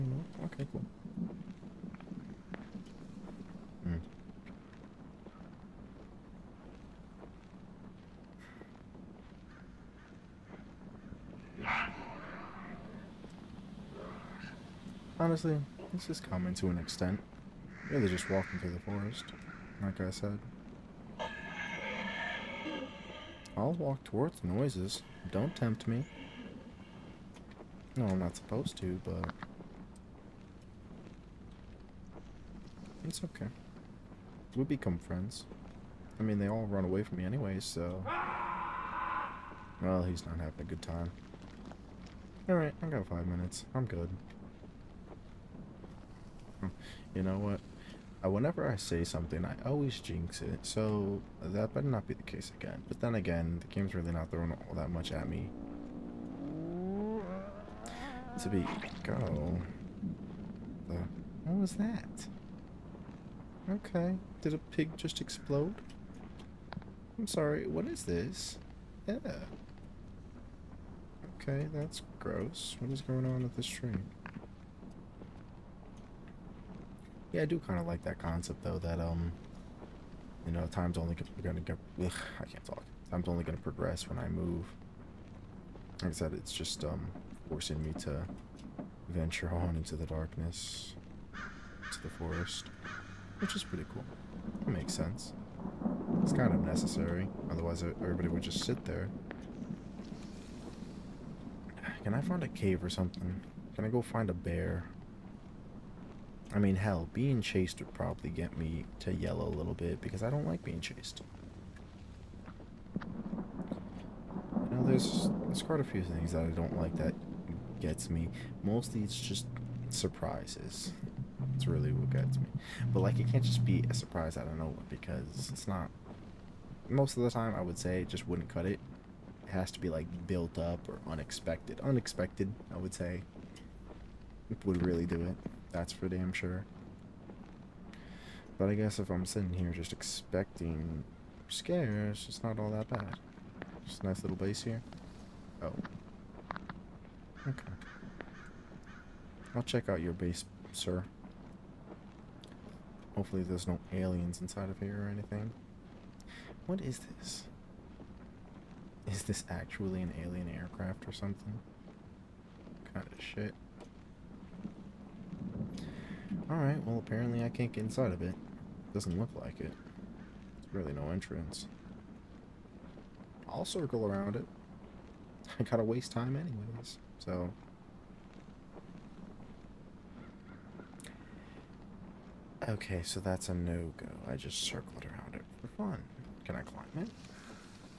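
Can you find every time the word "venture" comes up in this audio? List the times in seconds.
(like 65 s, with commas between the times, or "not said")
89 s.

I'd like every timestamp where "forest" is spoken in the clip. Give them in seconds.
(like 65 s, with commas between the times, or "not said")
18 s, 92 s.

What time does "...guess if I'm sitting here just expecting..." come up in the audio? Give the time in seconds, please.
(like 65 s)
138 s.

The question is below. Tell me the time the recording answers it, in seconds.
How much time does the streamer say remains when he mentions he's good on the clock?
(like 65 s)
43 s.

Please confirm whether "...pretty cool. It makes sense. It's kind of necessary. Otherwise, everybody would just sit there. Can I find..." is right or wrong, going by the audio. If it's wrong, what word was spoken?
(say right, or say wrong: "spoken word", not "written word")
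right.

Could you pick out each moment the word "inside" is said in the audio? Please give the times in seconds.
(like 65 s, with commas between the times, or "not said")
154 s, 167 s.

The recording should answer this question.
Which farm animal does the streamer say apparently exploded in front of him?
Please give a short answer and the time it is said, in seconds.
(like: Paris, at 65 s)
Pig, at 64 s.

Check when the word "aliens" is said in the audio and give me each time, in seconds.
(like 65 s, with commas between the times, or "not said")
153 s, 160 s.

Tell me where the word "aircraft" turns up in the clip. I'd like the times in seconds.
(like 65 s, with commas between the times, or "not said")
160 s.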